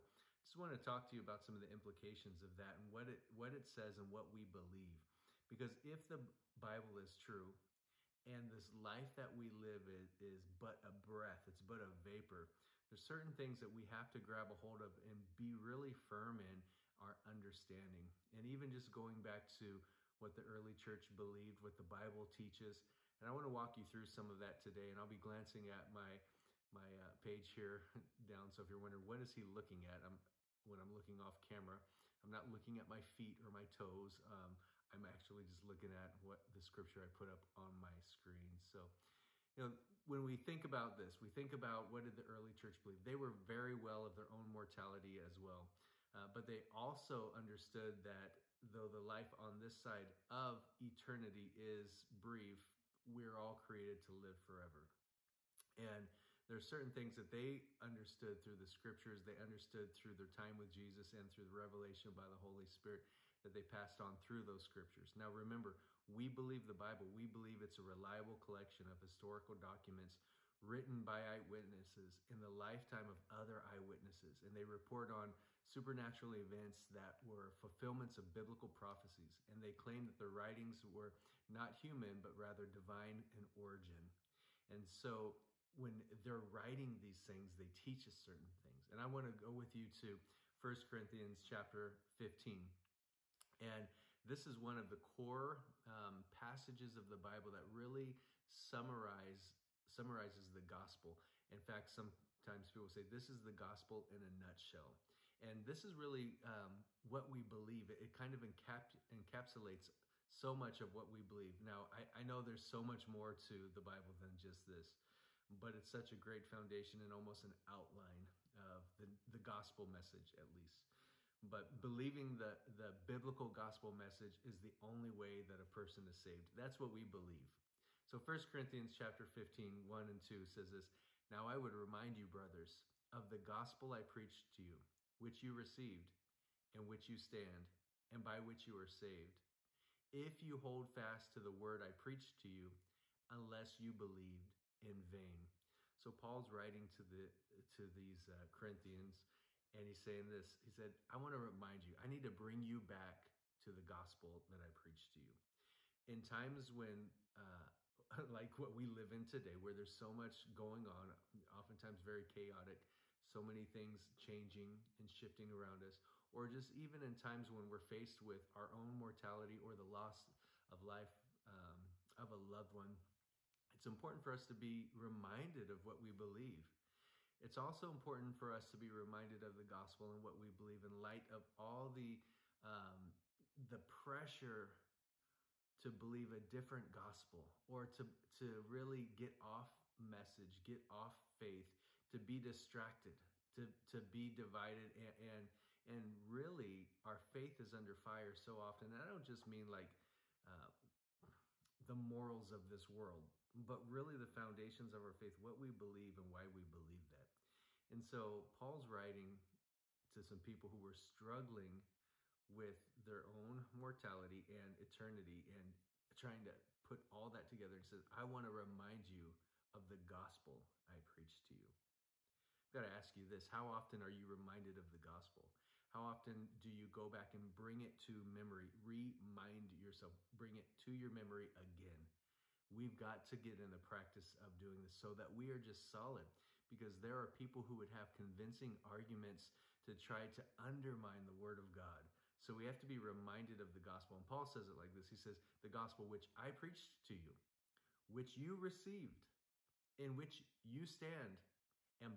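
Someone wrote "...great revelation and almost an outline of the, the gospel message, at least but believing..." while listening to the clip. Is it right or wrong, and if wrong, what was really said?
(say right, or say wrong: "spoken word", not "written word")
wrong: "foundation", not "revelation".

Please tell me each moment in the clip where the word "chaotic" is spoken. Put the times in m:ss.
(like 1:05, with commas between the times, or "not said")
2:42.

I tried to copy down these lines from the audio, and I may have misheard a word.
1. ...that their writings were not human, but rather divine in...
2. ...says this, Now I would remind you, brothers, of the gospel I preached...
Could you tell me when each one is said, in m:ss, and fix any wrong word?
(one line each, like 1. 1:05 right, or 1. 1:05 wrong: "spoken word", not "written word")
1. 1:20 right
2. 2:10 right.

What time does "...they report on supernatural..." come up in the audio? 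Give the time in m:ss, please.
1:14.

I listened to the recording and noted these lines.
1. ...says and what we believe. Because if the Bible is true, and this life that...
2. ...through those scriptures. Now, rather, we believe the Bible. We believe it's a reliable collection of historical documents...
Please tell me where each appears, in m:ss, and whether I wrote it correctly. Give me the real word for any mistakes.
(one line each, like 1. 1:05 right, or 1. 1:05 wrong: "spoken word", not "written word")
1. 0:03 right
2. 1:04 wrong: "remember", not "rather".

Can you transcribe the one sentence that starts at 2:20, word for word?
If you hold fast to the word I preached to you, unless you believed in vain.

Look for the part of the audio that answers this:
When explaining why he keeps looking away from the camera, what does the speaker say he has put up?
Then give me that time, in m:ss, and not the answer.
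0:36.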